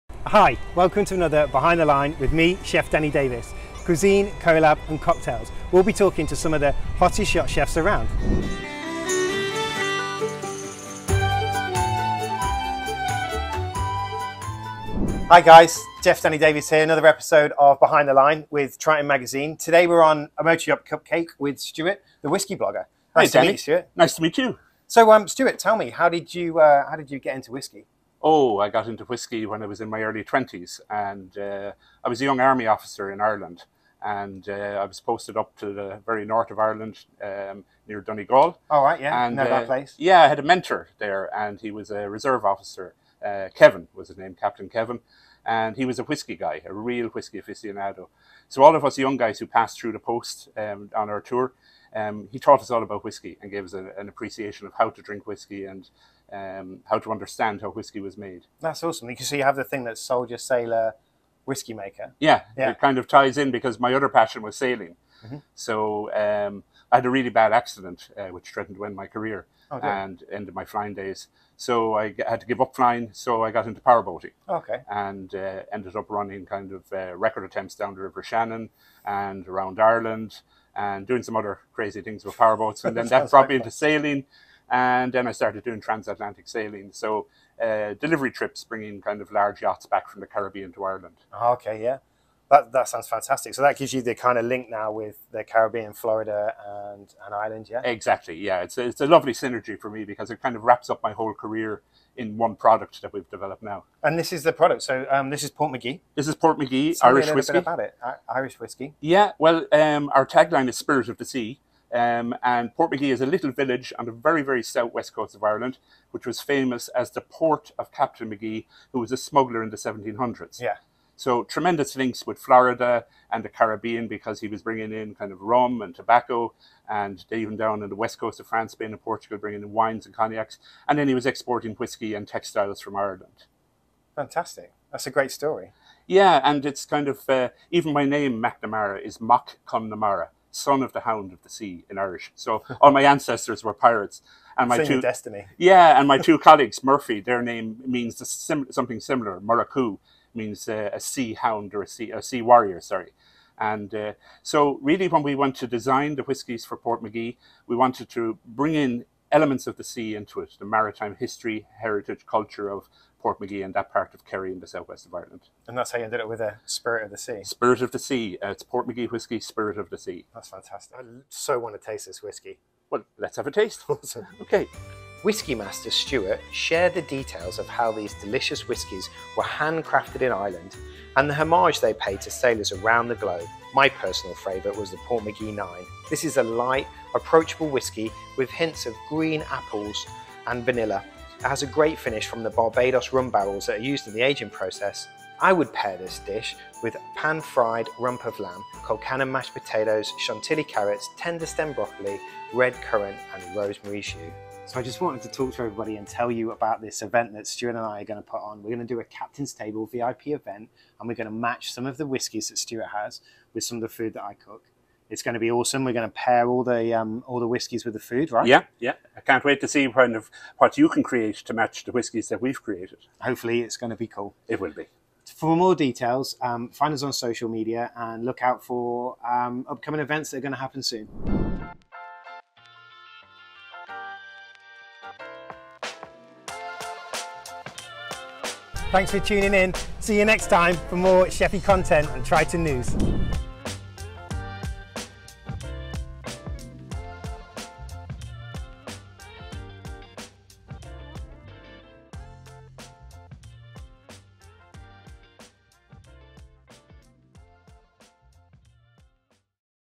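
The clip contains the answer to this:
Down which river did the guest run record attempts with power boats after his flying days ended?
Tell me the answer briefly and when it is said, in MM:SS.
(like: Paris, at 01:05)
River Shannon, at 01:18.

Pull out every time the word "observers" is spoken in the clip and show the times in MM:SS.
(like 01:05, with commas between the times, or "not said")
not said.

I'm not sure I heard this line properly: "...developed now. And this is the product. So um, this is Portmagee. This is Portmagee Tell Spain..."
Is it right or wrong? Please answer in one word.
wrong.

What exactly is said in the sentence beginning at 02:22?
So all my ancestors were pirates, and my two destiny.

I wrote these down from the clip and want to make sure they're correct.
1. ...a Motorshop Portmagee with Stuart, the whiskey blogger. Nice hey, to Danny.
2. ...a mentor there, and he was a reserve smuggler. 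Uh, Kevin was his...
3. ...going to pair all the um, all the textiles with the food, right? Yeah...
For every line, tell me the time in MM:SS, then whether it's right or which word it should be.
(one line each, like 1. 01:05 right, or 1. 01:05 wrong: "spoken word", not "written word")
1. 00:20 wrong: "Cupcake", not "Portmagee"
2. 00:40 wrong: "officer", not "smuggler"
3. 03:35 wrong: "whiskies", not "textiles".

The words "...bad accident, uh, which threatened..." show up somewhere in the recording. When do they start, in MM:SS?
01:07.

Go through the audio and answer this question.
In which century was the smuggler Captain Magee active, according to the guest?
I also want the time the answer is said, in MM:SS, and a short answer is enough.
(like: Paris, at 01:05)
1700s, at 01:59.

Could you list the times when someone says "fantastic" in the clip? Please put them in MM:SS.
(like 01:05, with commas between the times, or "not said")
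01:33, 02:14, 02:50.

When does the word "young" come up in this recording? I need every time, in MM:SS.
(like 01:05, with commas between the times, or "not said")
00:32, 00:48.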